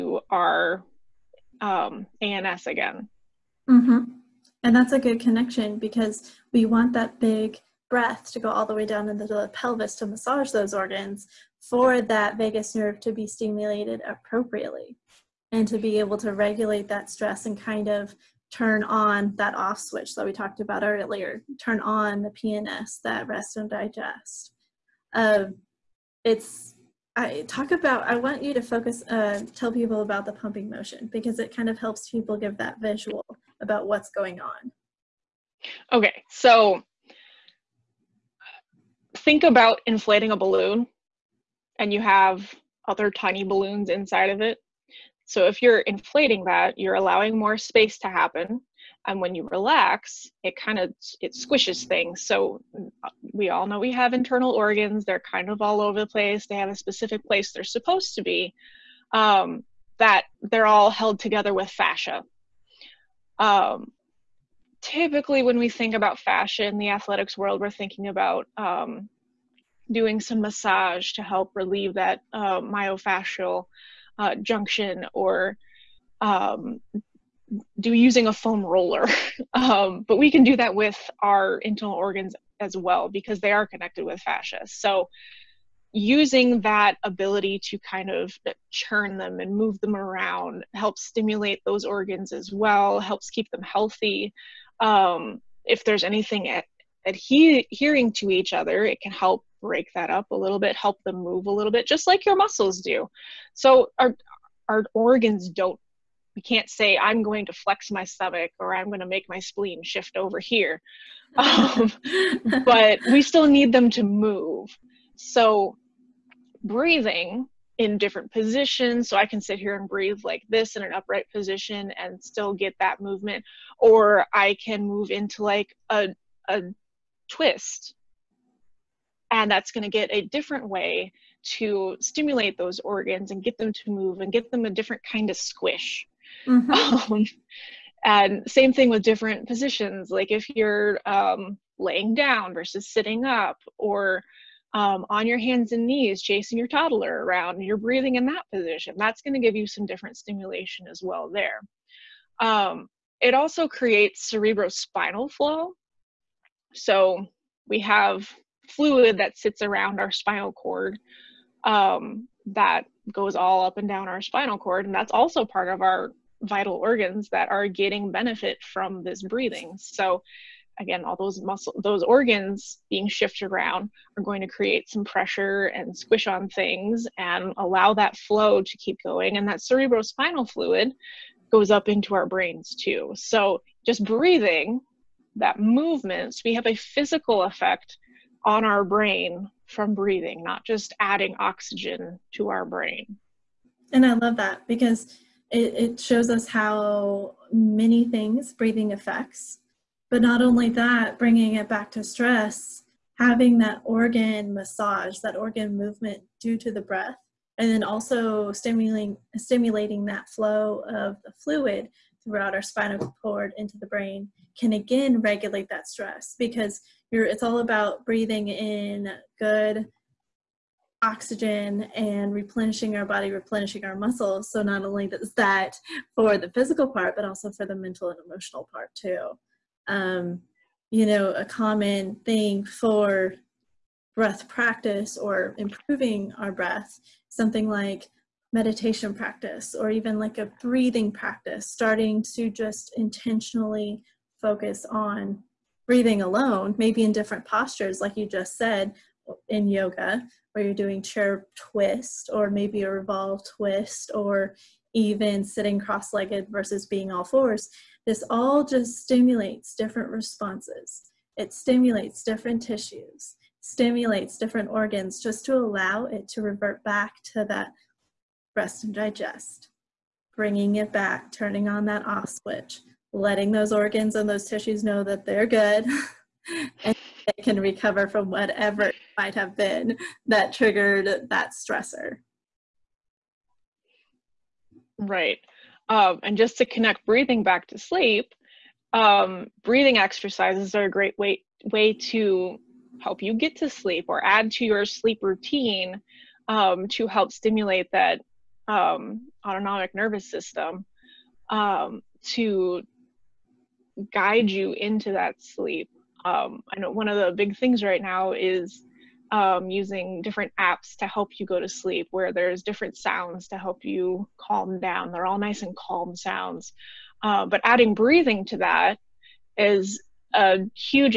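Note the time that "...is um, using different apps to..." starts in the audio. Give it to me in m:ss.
5:08.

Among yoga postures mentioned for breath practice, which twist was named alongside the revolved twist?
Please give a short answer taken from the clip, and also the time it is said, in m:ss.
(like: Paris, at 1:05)
Chair twist, at 4:11.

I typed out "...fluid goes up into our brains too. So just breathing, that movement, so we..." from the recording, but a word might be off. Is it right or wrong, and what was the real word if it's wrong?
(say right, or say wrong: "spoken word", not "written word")
right.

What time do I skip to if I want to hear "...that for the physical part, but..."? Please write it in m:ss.
3:45.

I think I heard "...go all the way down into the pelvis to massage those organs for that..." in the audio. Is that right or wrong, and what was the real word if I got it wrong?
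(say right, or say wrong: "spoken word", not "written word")
right.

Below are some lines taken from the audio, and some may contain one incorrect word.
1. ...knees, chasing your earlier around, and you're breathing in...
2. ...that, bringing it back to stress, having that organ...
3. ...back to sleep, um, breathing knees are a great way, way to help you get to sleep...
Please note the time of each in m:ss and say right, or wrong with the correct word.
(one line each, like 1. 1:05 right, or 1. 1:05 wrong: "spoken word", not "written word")
1. 2:25 wrong: "toddler", not "earlier"
2. 3:20 right
3. 4:47 wrong: "exercises", not "knees".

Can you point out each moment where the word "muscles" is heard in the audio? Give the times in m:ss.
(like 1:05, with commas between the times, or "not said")
1:42, 2:51, 3:43.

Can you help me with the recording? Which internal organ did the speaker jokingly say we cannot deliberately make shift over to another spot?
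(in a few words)
Spleen.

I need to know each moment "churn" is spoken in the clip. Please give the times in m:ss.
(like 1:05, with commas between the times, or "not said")
1:28.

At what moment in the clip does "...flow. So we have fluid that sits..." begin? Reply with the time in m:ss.
2:35.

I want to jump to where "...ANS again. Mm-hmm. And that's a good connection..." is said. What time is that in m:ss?
0:02.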